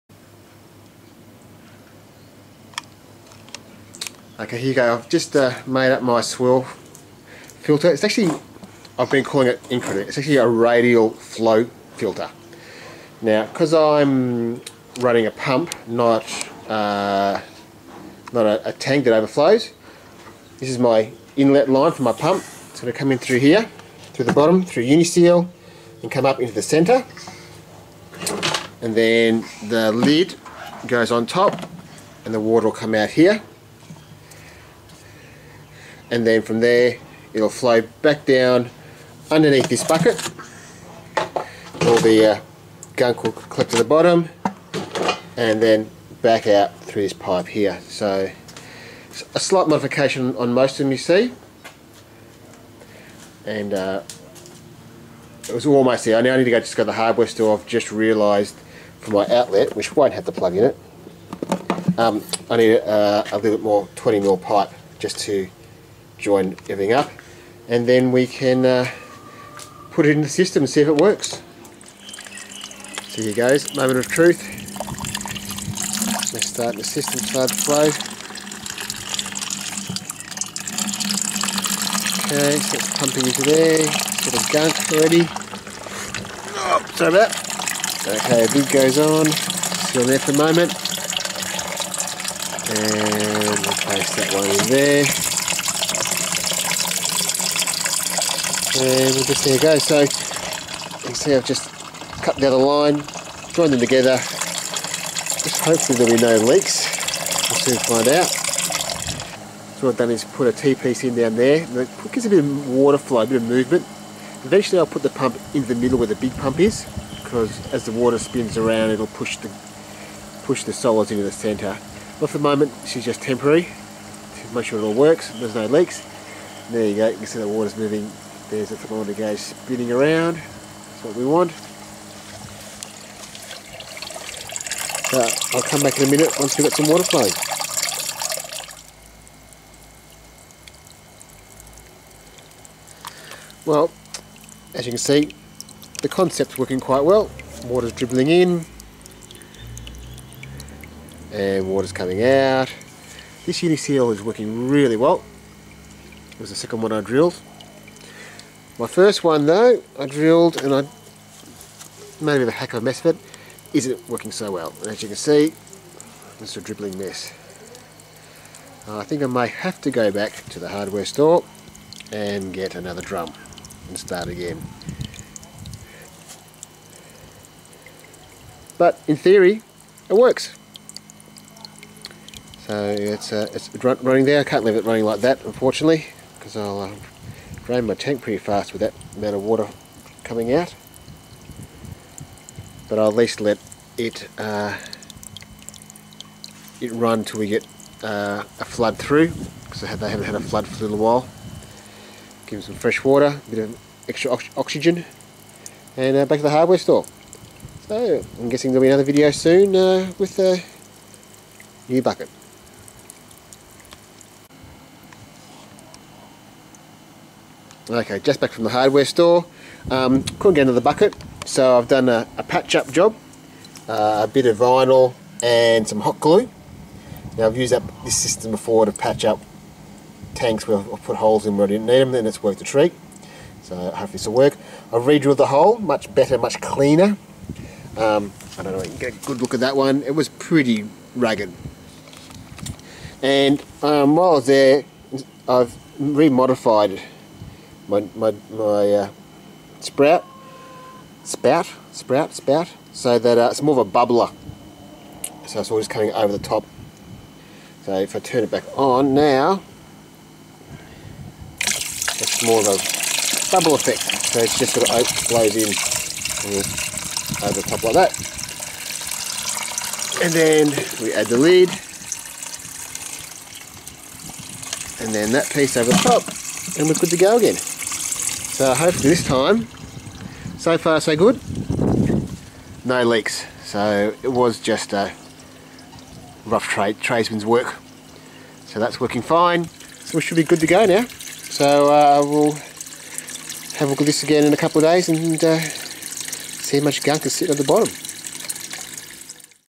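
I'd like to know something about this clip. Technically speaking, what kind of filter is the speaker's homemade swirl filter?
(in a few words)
radial flow filter.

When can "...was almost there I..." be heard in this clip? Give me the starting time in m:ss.
0:55.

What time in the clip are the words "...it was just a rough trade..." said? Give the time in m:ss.
4:44.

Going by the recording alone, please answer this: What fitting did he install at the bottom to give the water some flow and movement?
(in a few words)
T-piece.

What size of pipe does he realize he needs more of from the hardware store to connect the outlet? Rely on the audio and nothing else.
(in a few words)
20mm.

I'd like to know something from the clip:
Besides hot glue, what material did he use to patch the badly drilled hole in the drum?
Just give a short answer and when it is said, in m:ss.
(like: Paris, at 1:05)
vinyl, at 3:44.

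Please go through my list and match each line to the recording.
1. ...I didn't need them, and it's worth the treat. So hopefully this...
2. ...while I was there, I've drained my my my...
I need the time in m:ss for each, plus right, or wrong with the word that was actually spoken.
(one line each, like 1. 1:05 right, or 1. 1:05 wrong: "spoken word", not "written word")
1. 3:51 right
2. 4:04 wrong: "remodified", not "drained".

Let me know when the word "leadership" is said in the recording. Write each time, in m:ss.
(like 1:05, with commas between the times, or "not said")
not said.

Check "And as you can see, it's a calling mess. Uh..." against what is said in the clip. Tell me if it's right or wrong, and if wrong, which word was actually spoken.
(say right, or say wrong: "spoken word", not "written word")
wrong: "dribbling", not "calling".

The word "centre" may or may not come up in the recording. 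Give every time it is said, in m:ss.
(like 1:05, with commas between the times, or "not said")
0:26, 2:01.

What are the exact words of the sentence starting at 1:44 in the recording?
Just hopefully there'll be no leaks.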